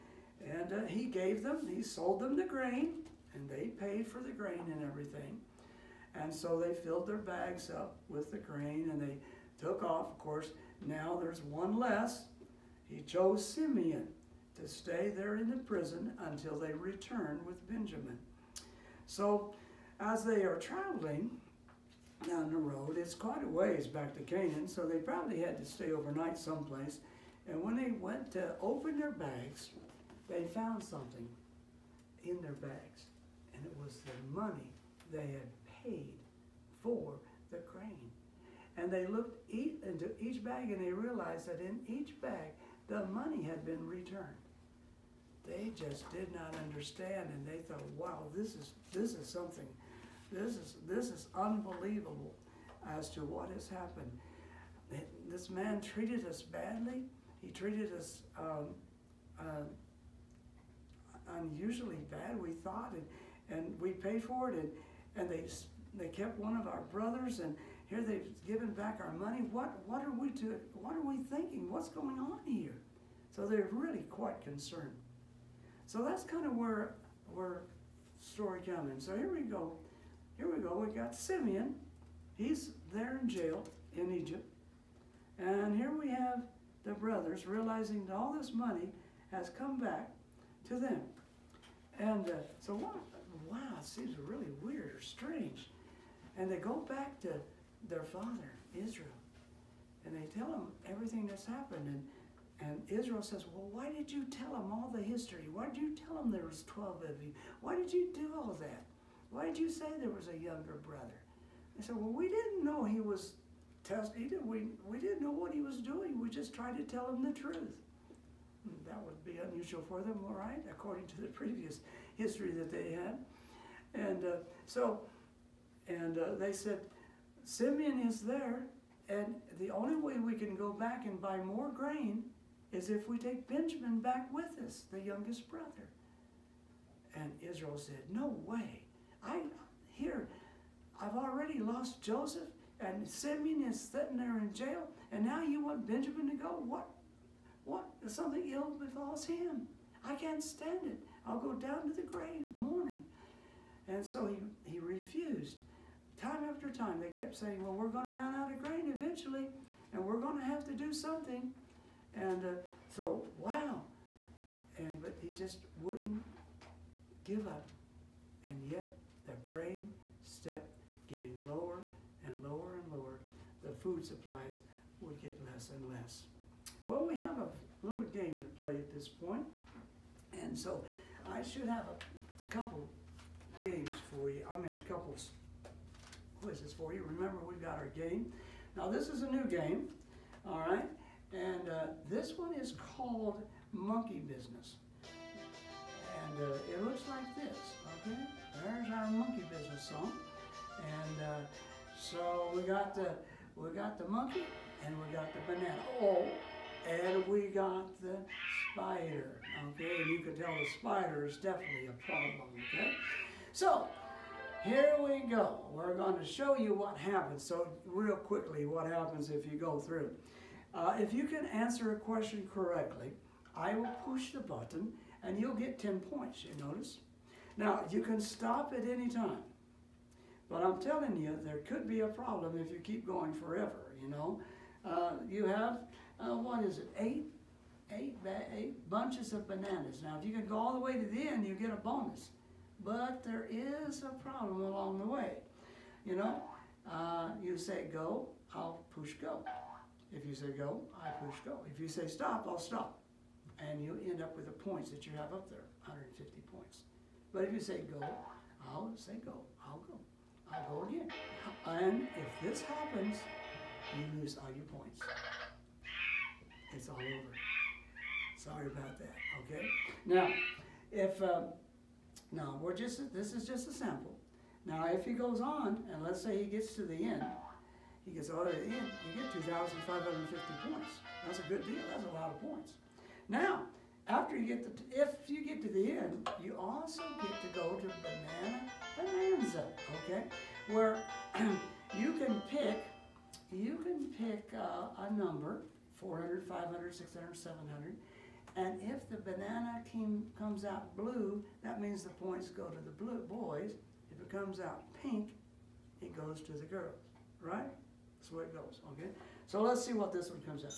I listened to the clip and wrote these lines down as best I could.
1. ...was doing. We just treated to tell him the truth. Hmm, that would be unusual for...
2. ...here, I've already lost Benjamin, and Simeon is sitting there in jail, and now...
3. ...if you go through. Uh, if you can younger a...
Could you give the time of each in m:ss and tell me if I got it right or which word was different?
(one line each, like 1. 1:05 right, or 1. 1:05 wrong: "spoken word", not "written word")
1. 1:55 wrong: "tried", not "treated"
2. 2:19 wrong: "Joseph", not "Benjamin"
3. 3:39 wrong: "answer", not "younger".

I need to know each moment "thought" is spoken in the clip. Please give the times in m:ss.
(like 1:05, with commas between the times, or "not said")
0:47, 1:02.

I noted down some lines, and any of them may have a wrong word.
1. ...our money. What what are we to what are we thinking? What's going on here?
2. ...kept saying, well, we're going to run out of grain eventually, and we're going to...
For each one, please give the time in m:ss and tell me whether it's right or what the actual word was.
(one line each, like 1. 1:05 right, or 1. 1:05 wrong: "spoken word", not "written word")
1. 1:09 right
2. 2:37 right.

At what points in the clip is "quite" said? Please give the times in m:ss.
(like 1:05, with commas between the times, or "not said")
0:23, 1:14.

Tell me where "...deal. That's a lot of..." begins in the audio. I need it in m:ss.
4:41.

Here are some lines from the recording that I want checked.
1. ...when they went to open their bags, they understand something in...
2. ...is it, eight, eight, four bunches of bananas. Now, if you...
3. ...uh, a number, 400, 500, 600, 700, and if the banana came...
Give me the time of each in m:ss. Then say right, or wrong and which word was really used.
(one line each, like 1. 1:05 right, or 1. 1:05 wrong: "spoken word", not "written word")
1. 0:27 wrong: "found", not "understand"
2. 3:56 wrong: "eight", not "four"
3. 4:54 right.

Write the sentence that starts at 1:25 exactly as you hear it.
And here we have the brothers realizing that all this money has come back to them.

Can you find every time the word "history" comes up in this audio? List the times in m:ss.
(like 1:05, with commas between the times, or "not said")
1:45, 2:02.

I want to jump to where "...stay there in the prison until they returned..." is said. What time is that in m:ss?
0:14.